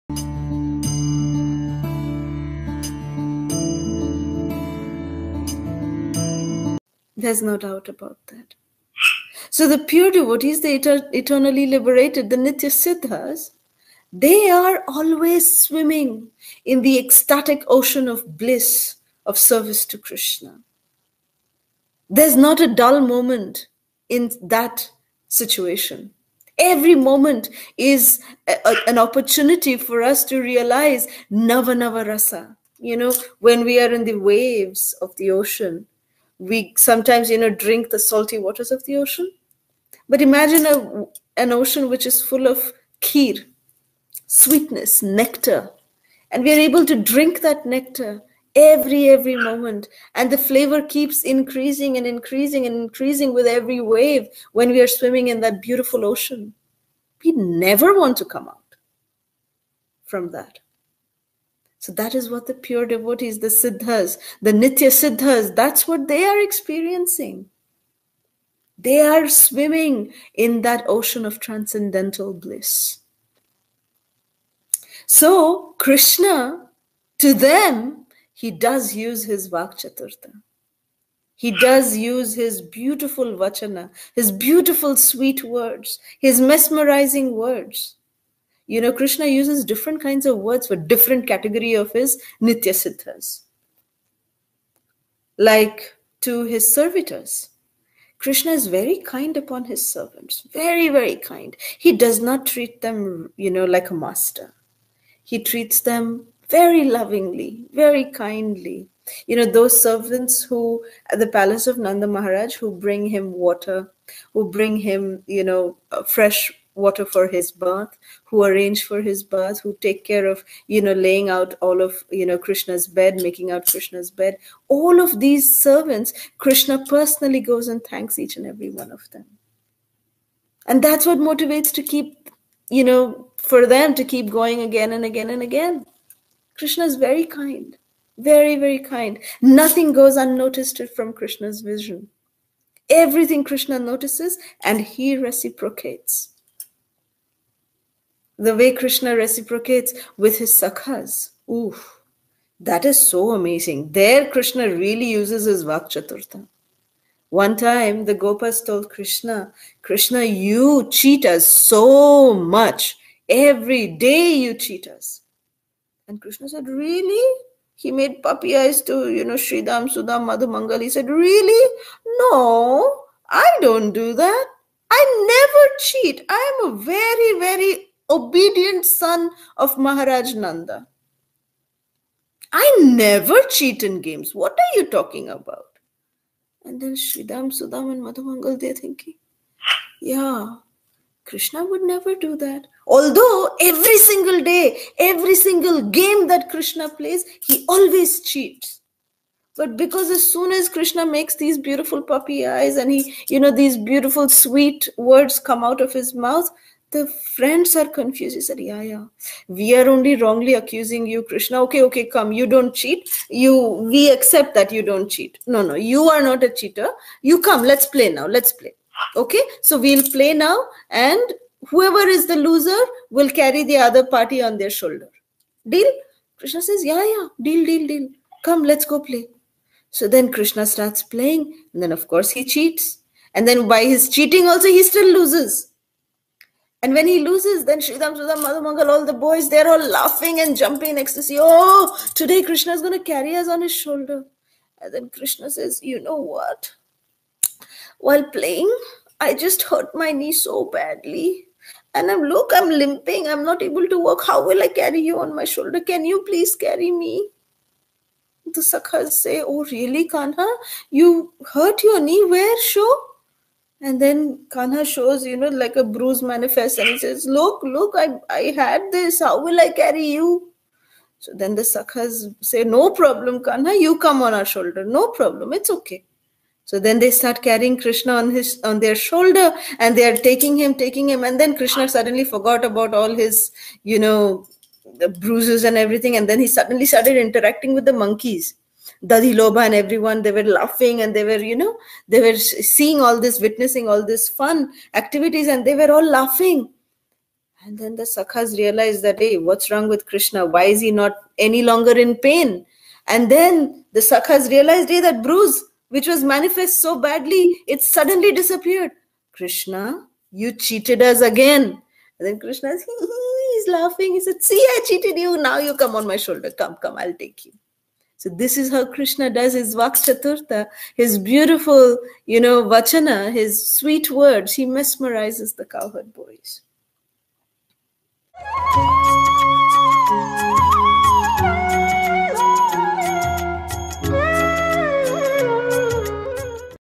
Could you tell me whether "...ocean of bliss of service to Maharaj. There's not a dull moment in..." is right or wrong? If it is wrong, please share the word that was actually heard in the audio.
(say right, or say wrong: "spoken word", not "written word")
wrong: "Krishna", not "Maharaj".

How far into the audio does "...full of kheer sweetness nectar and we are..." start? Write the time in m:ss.
0:42.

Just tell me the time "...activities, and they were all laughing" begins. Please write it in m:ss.
4:54.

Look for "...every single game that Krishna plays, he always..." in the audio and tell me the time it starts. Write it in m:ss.
3:14.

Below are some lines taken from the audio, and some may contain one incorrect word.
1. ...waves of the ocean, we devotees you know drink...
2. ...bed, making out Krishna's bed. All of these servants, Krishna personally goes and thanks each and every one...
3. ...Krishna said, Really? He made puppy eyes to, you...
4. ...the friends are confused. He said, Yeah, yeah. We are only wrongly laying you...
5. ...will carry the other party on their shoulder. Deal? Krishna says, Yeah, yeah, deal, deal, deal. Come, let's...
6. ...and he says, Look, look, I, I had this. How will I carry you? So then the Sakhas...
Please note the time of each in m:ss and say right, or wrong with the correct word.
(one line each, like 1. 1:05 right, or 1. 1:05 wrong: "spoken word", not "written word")
1. 0:34 wrong: "sometimes", not "devotees"
2. 2:02 right
3. 2:46 right
4. 3:26 wrong: "accusing", not "laying"
5. 3:43 right
6. 4:26 right.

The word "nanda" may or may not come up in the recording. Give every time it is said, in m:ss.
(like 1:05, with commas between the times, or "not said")
1:51, 3:00.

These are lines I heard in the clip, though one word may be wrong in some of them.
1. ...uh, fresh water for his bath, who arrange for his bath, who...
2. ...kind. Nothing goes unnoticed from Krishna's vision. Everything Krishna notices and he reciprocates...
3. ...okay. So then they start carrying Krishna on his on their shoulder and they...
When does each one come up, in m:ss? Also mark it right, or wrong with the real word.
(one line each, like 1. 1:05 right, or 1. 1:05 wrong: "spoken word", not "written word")
1. 1:55 right
2. 2:18 right
3. 4:35 right.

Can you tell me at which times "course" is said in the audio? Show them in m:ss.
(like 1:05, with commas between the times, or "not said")
3:52.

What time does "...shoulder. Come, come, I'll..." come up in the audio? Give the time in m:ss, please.
5:16.